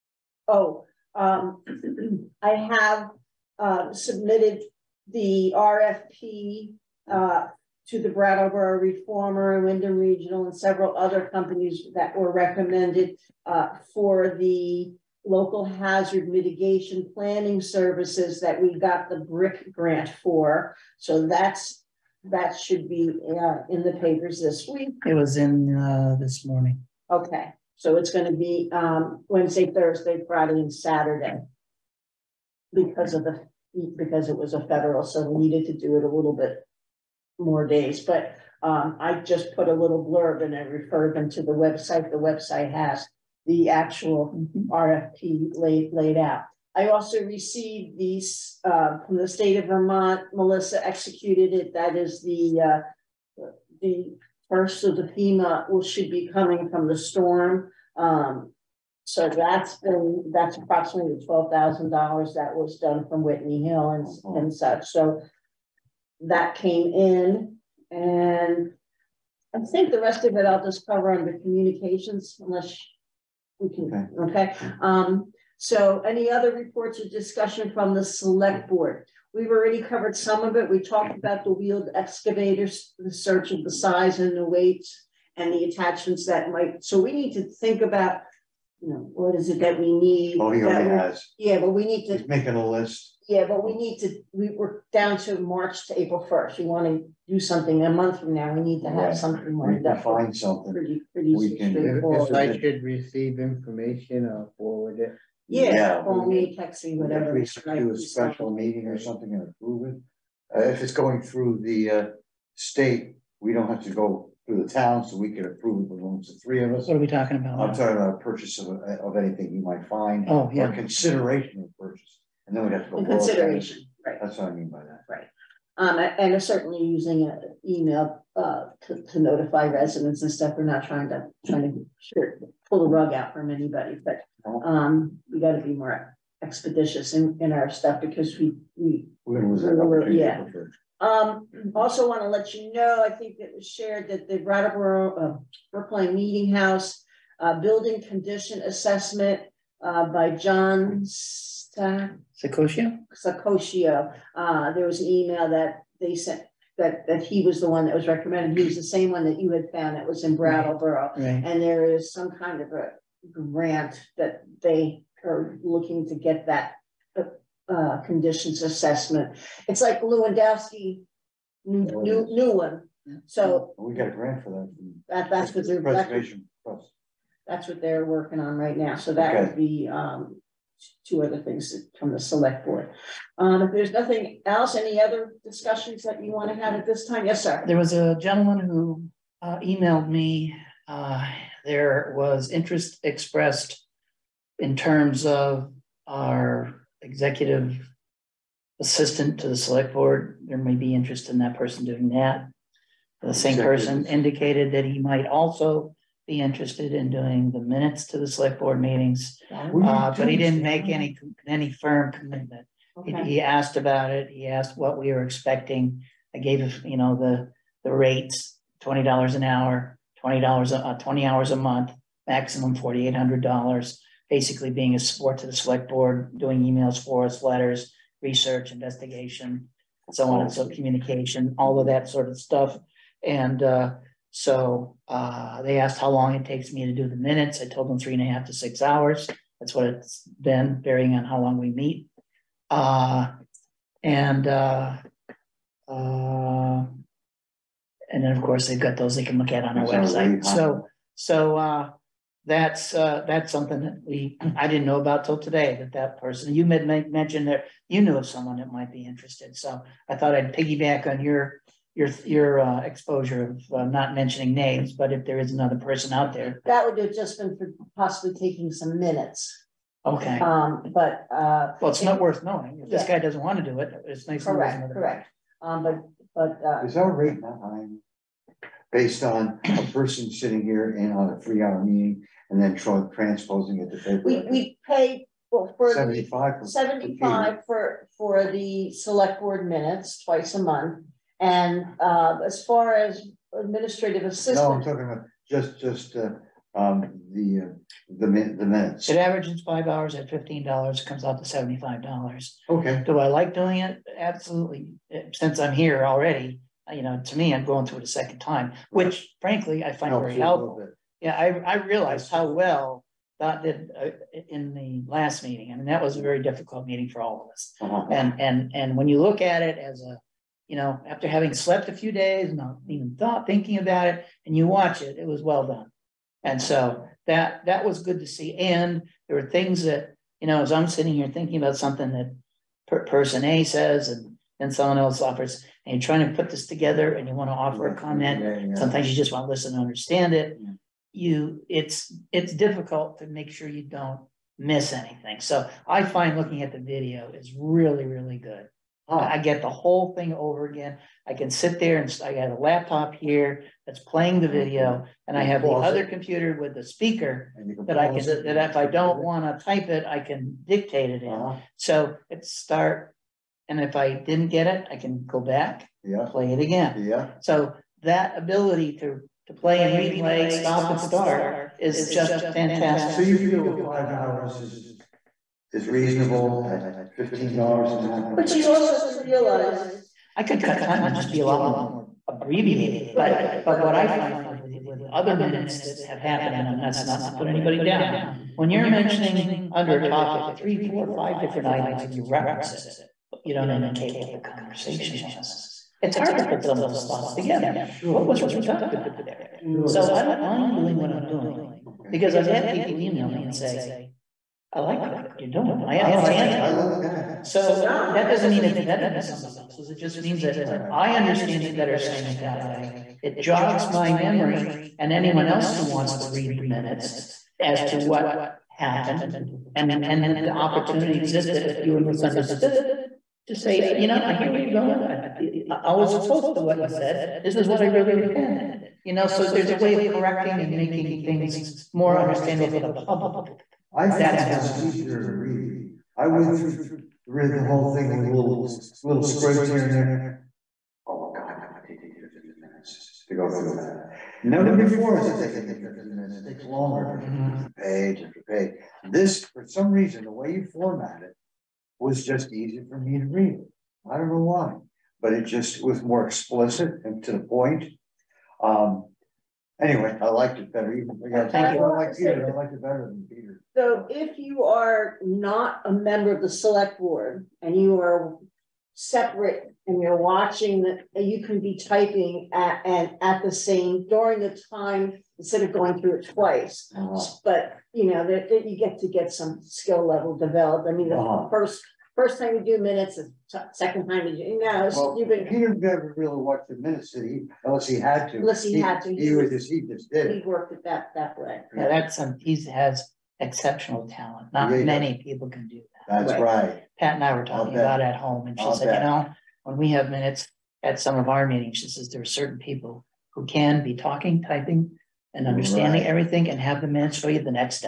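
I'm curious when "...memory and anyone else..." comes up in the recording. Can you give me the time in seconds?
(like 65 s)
414 s.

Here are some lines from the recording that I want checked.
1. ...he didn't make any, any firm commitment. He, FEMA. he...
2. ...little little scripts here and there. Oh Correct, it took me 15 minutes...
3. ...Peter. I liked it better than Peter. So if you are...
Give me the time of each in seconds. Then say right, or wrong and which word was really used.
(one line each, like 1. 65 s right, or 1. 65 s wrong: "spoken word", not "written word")
1. 210 s wrong: "Okay", not "FEMA"
2. 438 s wrong: "God", not "Correct"
3. 462 s right.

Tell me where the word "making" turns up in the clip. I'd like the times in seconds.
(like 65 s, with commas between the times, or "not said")
92 s, 430 s.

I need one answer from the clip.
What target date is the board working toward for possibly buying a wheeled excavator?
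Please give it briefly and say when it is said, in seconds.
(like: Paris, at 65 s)
April 1st, at 95 s.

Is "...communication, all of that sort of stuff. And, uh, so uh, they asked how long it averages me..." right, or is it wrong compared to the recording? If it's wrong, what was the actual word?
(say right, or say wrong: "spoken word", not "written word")
wrong: "takes", not "averages".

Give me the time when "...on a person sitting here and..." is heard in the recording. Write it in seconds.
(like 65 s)
279 s.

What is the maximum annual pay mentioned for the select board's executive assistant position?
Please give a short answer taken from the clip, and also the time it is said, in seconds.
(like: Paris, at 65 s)
$4,800, at 222 s.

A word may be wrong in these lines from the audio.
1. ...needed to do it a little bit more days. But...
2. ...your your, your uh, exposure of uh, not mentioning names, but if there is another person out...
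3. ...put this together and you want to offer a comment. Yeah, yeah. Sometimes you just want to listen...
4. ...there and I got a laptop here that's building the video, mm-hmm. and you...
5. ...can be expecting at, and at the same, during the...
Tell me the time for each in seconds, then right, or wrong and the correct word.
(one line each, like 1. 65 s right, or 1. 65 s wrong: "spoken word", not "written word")
1. 35 s right
2. 261 s right
3. 336 s right
4. 351 s wrong: "playing", not "building"
5. 471 s wrong: "typing", not "expecting".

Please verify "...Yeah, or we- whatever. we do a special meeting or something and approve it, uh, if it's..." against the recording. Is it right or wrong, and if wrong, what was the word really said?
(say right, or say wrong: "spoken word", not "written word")
right.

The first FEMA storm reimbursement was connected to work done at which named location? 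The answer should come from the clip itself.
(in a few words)
Whitney Hill.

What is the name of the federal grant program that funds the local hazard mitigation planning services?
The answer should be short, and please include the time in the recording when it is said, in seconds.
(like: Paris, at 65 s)
BRIC, at 19 s.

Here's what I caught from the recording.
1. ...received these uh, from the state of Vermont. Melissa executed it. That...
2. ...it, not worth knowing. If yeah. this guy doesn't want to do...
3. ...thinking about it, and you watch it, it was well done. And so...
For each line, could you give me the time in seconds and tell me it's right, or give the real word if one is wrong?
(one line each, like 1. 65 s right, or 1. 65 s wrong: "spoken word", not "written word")
1. 47 s right
2. 271 s right
3. 323 s right.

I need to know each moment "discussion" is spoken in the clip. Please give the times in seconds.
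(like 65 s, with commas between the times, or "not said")
77 s, 185 s.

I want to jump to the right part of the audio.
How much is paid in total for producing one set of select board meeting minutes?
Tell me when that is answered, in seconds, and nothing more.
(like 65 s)
301 s.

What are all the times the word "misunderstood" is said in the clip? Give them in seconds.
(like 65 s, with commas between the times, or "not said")
422 s.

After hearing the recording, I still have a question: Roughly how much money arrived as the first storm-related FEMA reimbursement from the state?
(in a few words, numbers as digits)
$12,000.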